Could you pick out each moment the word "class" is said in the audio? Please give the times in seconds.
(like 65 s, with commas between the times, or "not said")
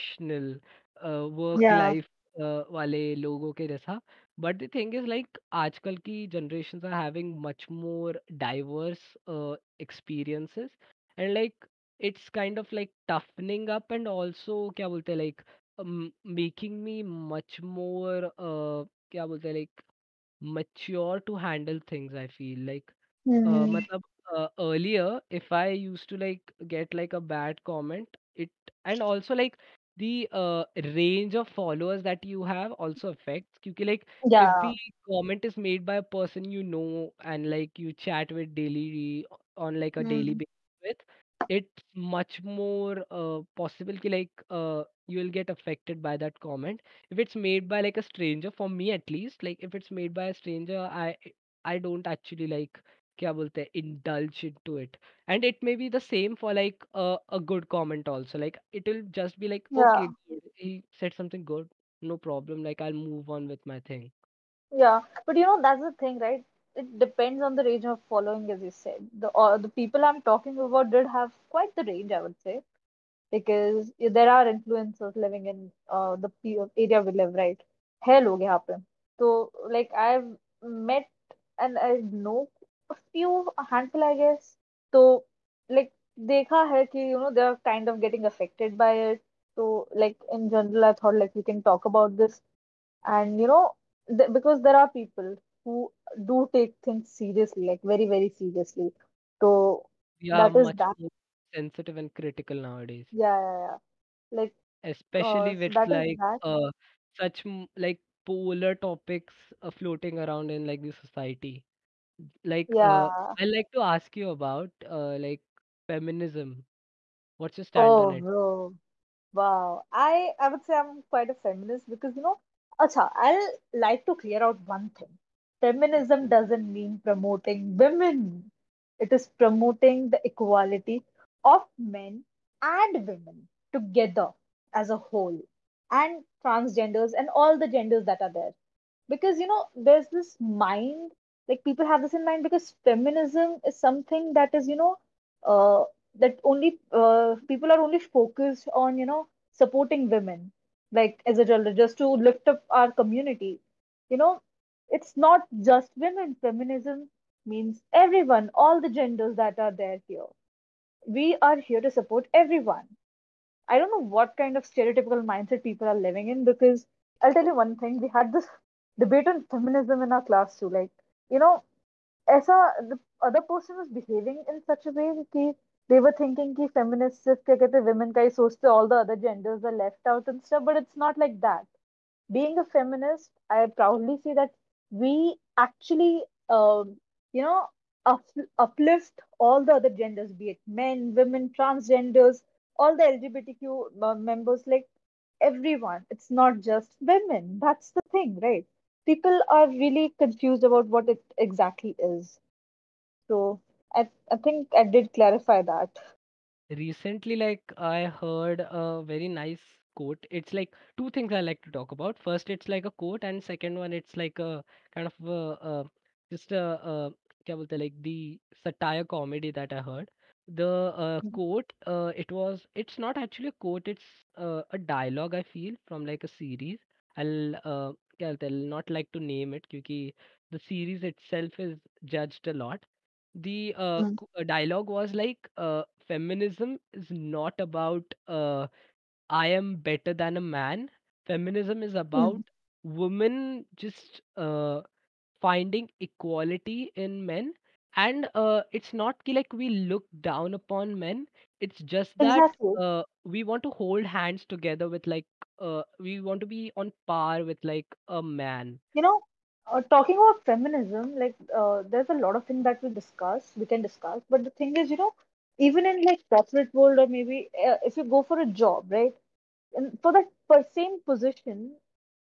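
170 s.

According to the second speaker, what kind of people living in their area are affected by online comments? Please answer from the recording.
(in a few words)
influencers.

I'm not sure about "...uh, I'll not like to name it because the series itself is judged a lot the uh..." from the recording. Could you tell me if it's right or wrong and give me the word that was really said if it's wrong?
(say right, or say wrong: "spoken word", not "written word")
right.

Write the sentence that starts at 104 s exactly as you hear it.
Like especially uh, with like uh, such like polar topics uh, floating around in like the society.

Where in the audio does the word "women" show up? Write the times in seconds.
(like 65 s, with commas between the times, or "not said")
127 s, 133 s, 150 s, 155 s, 177 s, 191 s, 196 s, 243 s.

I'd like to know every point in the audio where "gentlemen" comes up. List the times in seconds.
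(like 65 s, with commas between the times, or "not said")
not said.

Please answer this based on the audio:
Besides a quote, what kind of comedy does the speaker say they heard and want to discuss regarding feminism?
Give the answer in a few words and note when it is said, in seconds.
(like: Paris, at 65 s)
satire comedy, at 218 s.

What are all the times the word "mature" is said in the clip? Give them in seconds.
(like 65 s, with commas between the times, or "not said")
20 s.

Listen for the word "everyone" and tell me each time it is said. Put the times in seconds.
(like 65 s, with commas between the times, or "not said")
157 s, 162 s, 195 s.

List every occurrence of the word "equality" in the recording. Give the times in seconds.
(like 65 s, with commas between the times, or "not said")
130 s, 246 s.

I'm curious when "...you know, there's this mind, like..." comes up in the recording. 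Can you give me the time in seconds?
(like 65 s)
139 s.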